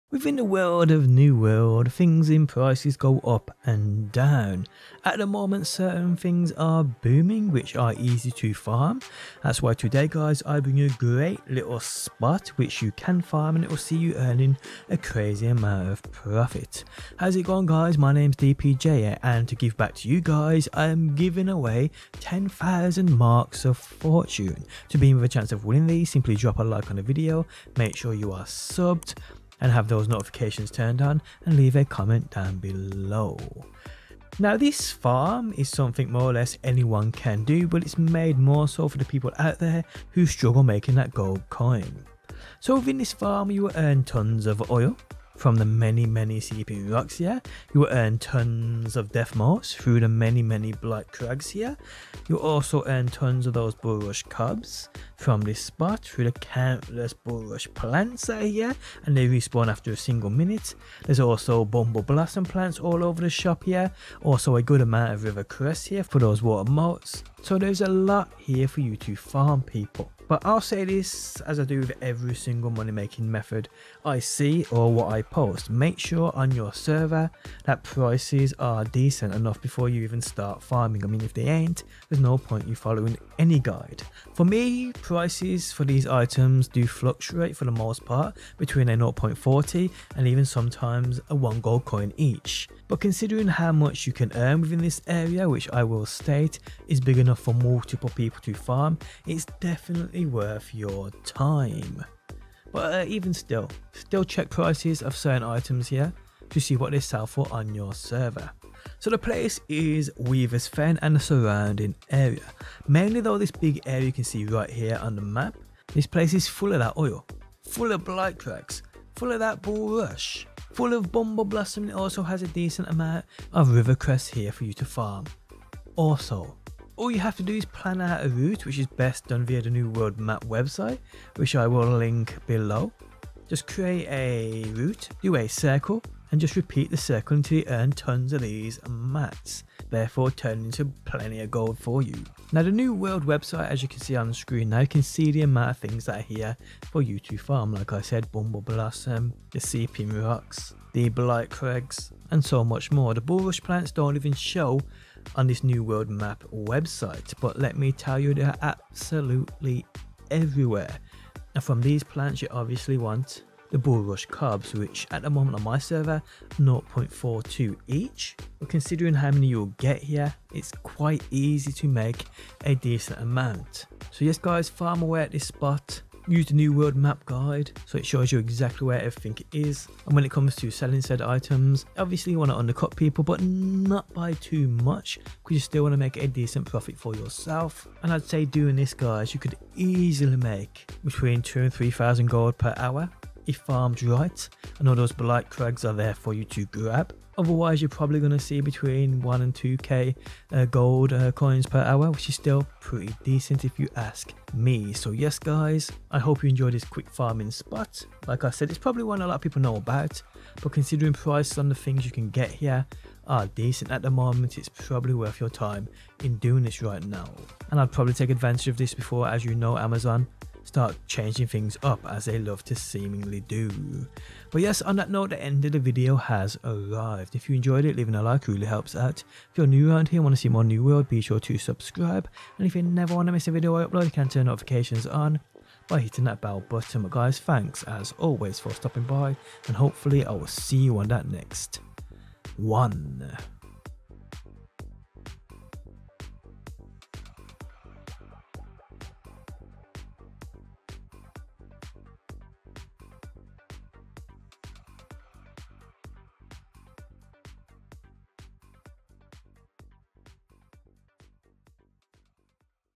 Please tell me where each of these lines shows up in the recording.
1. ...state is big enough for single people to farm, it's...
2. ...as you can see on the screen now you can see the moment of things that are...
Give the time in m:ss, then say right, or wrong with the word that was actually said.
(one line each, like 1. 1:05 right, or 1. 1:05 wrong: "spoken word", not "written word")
1. 1:36 wrong: "multiple", not "single"
2. 2:23 wrong: "amount", not "moment".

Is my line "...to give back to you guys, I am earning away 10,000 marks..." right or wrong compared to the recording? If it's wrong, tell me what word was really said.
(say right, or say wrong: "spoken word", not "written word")
wrong: "giving", not "earning".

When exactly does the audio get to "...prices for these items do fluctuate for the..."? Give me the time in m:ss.
1:24.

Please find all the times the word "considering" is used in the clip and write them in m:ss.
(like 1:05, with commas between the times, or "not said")
1:32, 2:48, 3:30.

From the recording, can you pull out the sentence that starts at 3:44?
But yes, on that note, the end of the video has arrived.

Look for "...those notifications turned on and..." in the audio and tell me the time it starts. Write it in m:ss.
0:29.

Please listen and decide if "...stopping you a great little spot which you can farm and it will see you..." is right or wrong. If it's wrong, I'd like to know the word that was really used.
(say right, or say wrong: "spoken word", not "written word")
wrong: "bring", not "stopping".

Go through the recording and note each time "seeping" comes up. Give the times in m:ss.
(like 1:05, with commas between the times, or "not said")
0:46.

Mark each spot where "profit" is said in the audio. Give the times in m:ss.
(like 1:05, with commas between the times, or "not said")
0:16, 3:06.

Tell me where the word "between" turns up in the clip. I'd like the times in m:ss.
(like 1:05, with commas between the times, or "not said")
1:28, 3:11, 3:18.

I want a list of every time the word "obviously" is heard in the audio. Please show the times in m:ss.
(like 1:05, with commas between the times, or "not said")
2:42, 3:01.